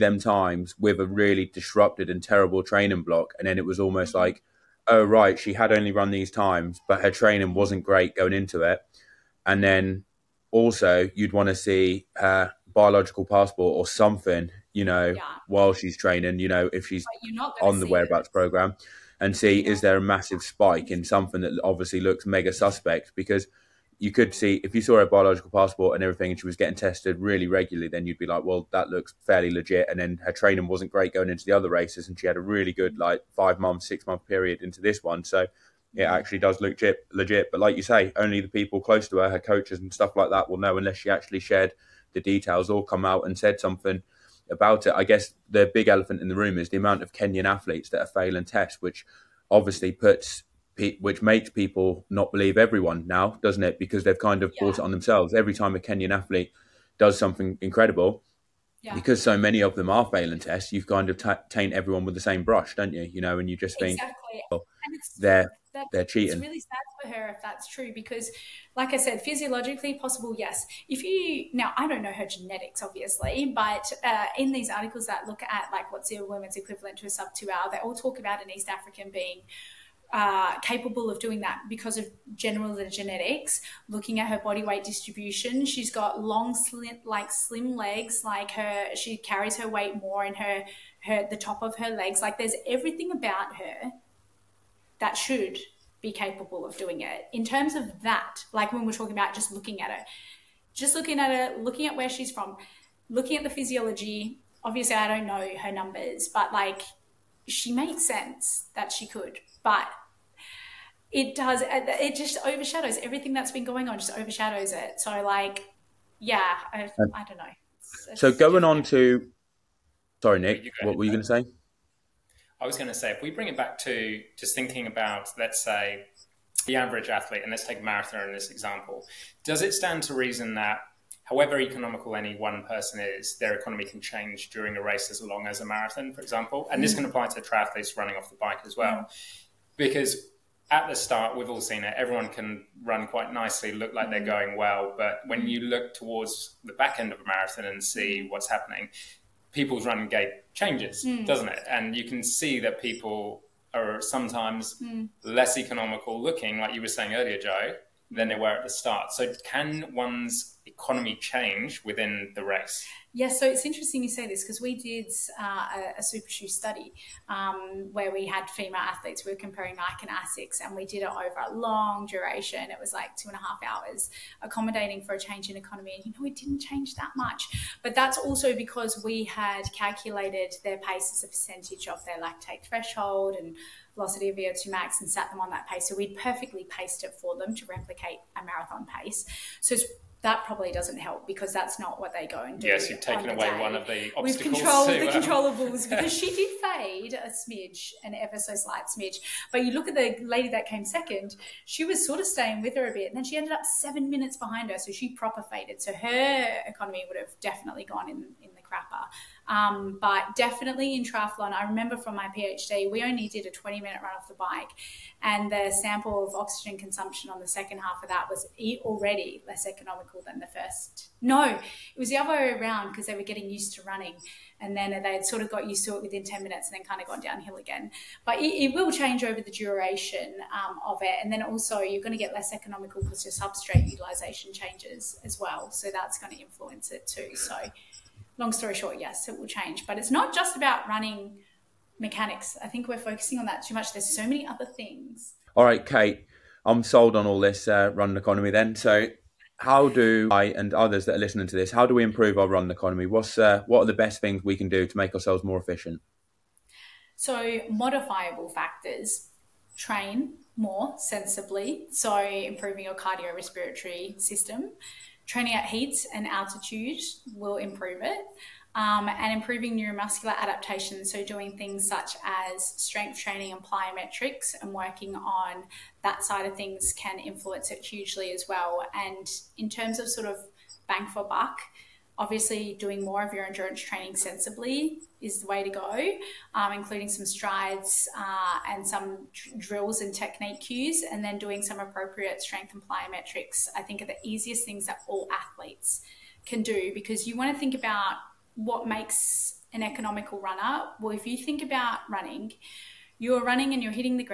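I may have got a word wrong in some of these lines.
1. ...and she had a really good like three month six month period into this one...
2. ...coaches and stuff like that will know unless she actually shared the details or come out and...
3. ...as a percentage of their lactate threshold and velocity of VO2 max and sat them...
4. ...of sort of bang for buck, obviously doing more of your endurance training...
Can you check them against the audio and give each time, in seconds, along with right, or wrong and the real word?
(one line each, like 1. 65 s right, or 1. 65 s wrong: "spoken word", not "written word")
1. 32 s wrong: "five", not "three"
2. 39 s right
3. 181 s right
4. 279 s right.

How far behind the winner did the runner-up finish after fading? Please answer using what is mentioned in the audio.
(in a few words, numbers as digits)
7 minutes.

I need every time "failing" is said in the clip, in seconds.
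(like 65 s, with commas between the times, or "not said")
48 s, 60 s.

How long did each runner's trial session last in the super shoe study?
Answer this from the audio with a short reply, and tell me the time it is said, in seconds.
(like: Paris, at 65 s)
2.5 hours, at 173 s.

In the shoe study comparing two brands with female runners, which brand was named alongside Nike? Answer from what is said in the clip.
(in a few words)
ASICS.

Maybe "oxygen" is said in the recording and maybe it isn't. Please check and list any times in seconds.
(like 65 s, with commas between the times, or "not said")
216 s.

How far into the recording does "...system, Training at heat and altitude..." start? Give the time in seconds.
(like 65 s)
264 s.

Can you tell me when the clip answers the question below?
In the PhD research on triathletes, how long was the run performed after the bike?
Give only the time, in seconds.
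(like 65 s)
213 s.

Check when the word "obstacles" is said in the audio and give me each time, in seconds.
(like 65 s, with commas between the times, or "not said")
194 s.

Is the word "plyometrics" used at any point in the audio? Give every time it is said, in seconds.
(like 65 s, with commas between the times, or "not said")
273 s, 292 s.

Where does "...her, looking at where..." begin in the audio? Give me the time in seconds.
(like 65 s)
101 s.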